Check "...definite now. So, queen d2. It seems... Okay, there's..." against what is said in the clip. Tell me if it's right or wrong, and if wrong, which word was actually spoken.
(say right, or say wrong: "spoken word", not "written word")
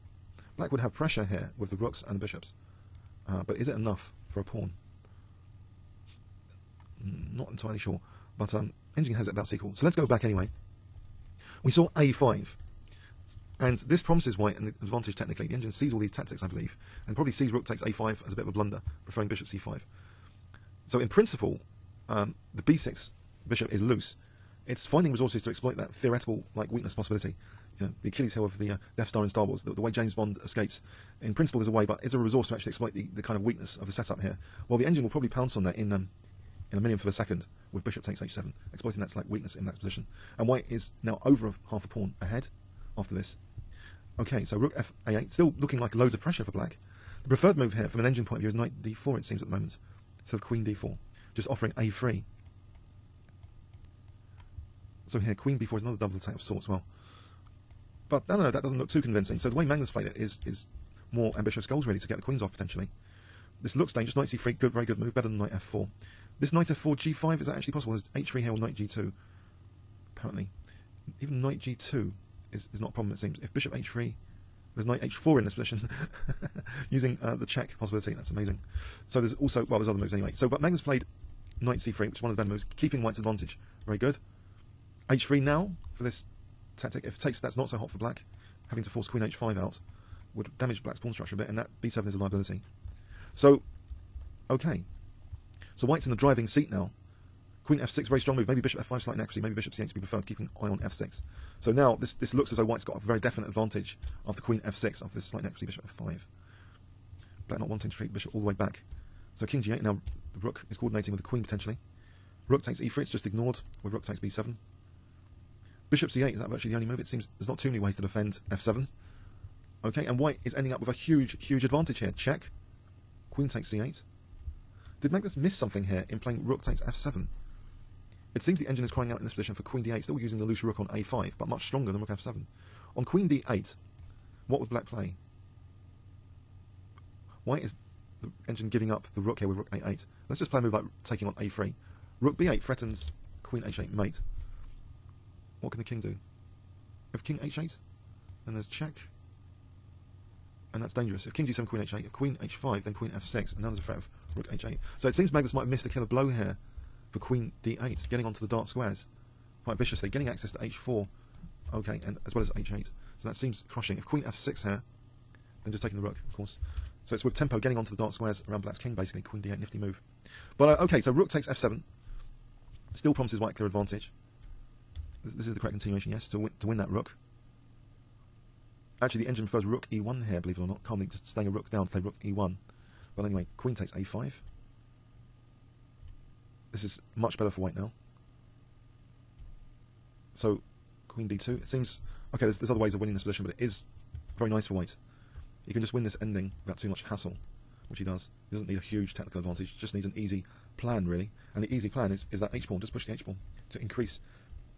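wrong: "white", not "definite".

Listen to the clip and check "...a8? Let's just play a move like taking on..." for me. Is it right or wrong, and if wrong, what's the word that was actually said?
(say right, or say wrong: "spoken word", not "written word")
right.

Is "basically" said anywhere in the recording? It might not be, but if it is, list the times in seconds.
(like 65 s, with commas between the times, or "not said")
168 s.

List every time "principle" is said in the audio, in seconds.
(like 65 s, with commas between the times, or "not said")
21 s, 31 s.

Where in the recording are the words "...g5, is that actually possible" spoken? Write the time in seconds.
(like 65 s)
66 s.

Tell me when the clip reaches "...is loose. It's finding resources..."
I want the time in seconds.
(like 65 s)
23 s.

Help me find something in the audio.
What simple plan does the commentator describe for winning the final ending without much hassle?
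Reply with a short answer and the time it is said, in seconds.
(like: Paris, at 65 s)
Push the h-pawn, at 202 s.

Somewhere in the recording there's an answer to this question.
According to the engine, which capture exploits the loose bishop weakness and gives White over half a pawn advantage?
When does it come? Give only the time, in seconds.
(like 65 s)
37 s.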